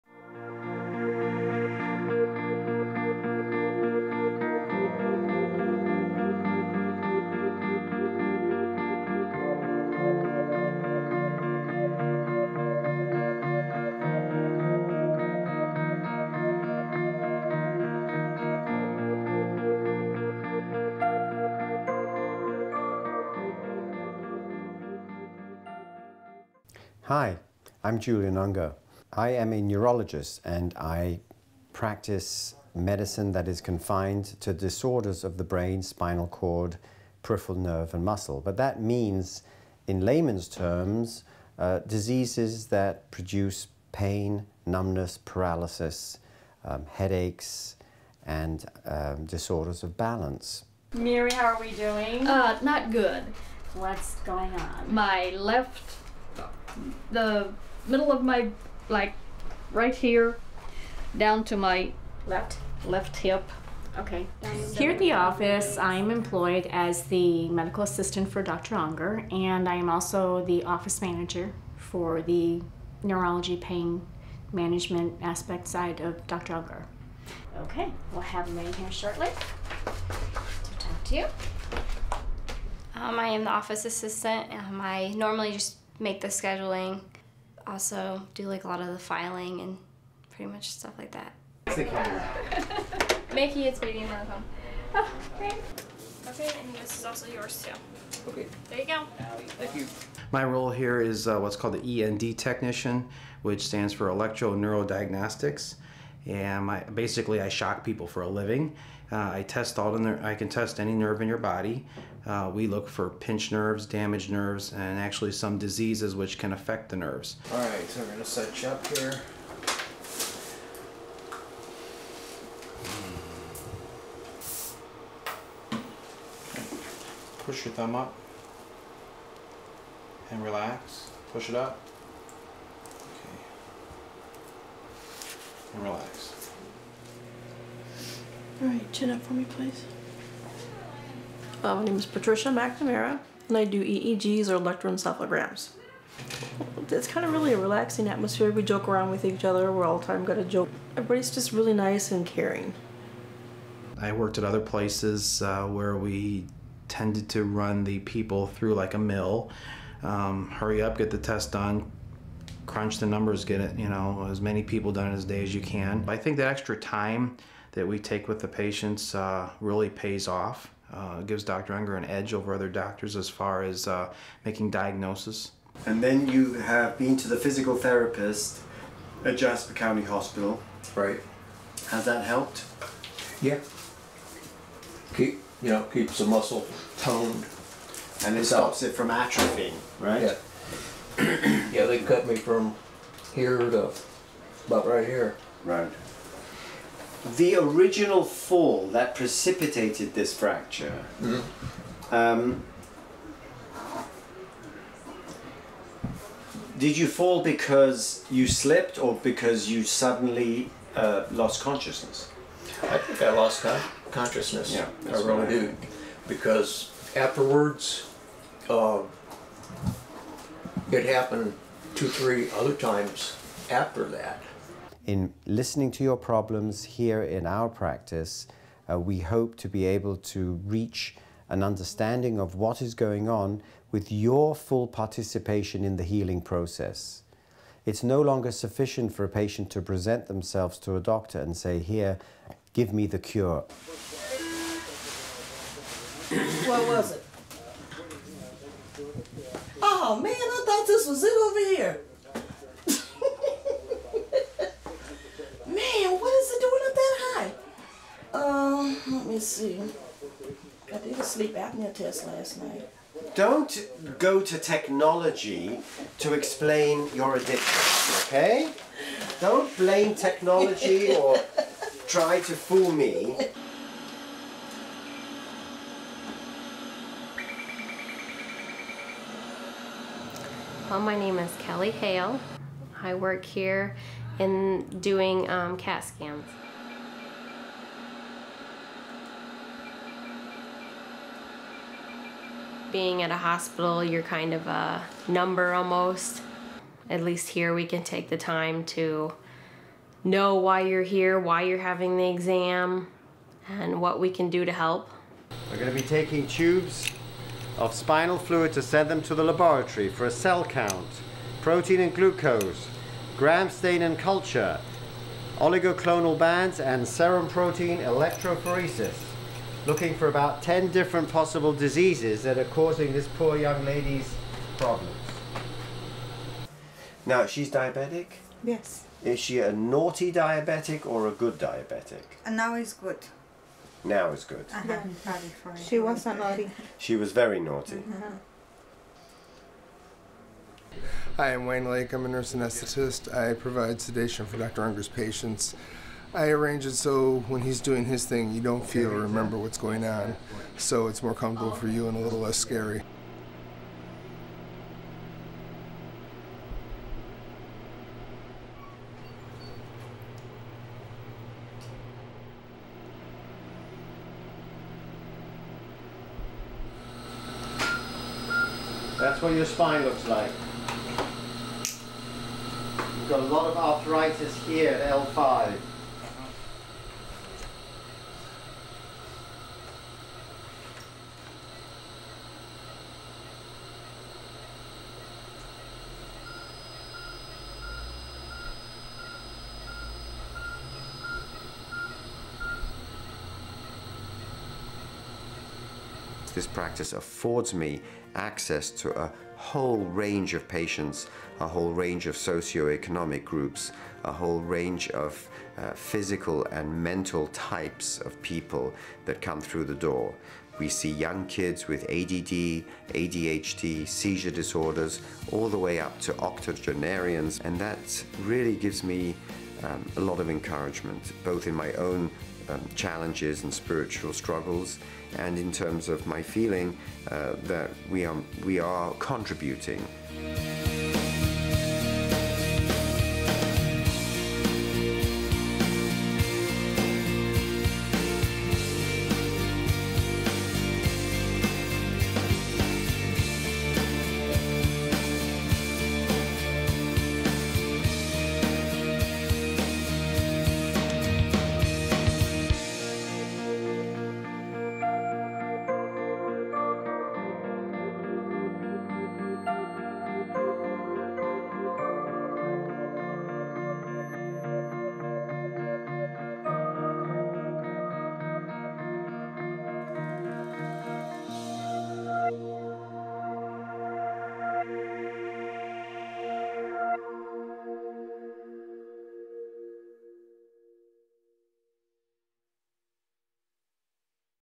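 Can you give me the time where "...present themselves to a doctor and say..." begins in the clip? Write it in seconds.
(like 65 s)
239 s.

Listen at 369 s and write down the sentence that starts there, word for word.
That's what your spine looks like.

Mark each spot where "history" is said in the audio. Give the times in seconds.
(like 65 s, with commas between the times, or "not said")
not said.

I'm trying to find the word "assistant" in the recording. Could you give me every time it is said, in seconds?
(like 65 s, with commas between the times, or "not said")
67 s, 83 s.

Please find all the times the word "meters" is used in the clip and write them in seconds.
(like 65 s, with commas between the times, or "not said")
not said.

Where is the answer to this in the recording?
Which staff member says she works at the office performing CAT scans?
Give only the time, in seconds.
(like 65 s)
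281 s.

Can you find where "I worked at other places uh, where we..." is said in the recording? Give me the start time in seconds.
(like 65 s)
153 s.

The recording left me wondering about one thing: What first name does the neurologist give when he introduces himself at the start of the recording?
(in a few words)
Julian.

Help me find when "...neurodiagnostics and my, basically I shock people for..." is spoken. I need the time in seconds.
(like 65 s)
104 s.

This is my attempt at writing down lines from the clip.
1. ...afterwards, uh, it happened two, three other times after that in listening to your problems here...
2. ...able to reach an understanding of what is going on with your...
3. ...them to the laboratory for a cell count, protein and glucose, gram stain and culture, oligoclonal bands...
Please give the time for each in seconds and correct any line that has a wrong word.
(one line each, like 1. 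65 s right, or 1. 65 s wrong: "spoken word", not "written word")
1. 217 s right
2. 229 s right
3. 309 s right.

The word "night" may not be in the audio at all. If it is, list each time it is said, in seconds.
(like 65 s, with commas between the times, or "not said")
262 s.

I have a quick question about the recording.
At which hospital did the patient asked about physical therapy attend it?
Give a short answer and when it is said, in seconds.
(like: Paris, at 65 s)
Jasper County Hospital, at 179 s.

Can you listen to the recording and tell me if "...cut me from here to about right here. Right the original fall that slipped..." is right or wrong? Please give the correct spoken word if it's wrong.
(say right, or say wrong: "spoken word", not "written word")
wrong: "precipitated", not "slipped".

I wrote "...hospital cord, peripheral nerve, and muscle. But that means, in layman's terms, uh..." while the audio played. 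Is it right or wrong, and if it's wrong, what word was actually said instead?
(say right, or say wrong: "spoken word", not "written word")
wrong: "spinal", not "hospital".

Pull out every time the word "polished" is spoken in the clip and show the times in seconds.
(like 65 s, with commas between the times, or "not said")
not said.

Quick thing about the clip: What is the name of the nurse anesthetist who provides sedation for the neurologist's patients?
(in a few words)
Wayne Lake.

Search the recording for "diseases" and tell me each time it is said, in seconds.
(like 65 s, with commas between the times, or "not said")
41 s, 115 s, 321 s.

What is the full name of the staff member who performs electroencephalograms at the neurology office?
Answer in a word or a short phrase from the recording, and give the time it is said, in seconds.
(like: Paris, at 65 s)
Patricia McNamara, at 142 s.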